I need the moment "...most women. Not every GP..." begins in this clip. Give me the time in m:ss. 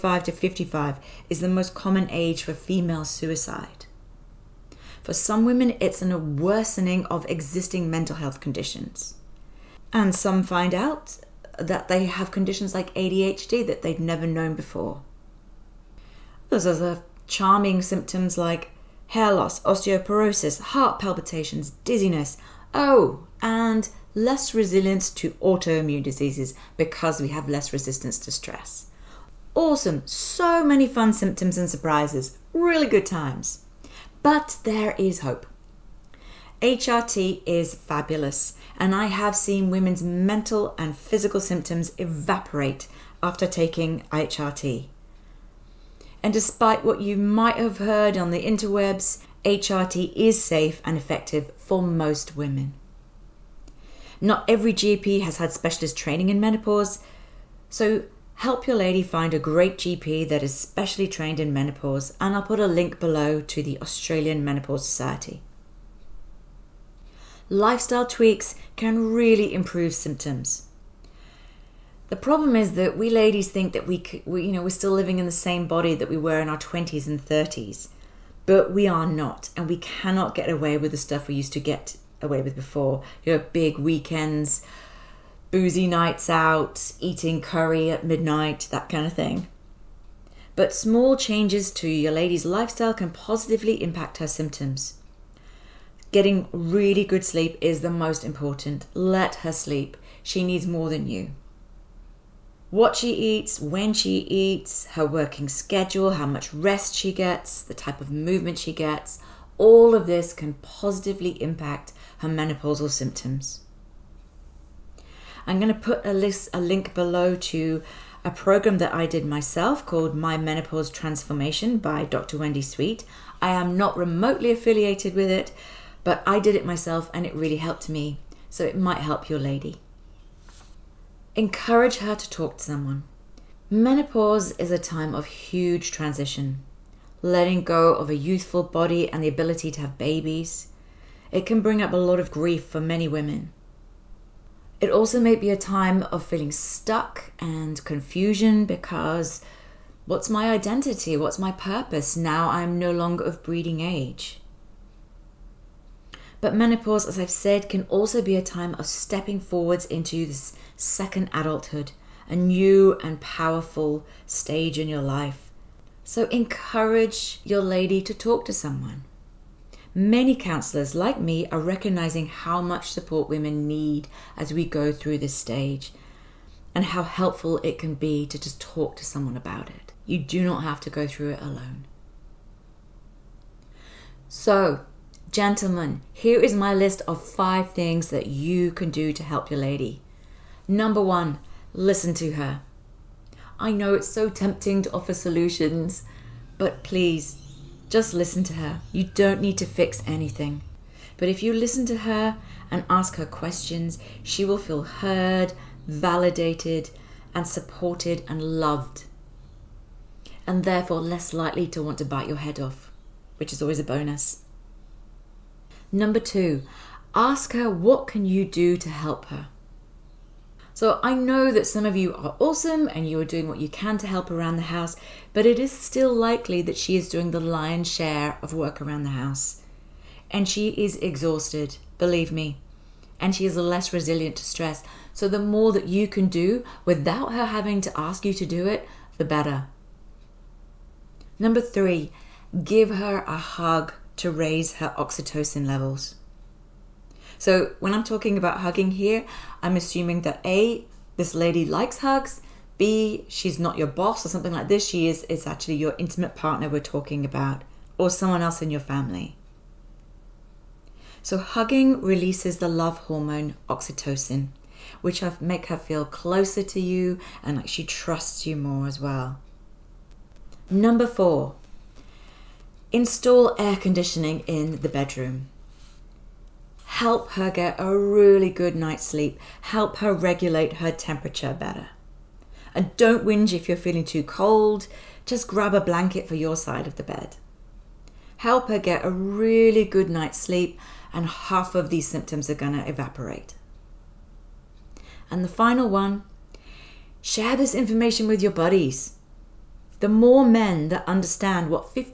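0:51.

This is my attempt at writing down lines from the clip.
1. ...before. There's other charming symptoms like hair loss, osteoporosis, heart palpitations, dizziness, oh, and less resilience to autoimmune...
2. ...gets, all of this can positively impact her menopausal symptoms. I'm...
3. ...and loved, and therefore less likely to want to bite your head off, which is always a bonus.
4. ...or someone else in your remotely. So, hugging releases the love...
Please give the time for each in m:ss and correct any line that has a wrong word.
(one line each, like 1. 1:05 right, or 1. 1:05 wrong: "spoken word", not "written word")
1. 0:14 right
2. 1:48 right
3. 3:28 right
4. 4:17 wrong: "family", not "remotely".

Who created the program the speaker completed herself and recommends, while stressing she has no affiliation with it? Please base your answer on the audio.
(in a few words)
Dr. Wendy Sweet.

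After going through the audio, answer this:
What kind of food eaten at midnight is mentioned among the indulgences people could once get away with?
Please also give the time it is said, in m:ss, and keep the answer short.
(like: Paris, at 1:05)
curry, at 1:27.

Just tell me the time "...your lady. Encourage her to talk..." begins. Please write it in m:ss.
2:09.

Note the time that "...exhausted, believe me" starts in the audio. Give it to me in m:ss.
3:50.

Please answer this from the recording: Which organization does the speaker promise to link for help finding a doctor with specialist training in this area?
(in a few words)
Australian Menopause Society.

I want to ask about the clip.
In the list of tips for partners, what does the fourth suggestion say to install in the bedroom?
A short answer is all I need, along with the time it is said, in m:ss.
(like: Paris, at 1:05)
air conditioning, at 4:33.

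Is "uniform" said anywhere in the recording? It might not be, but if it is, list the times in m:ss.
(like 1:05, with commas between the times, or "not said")
not said.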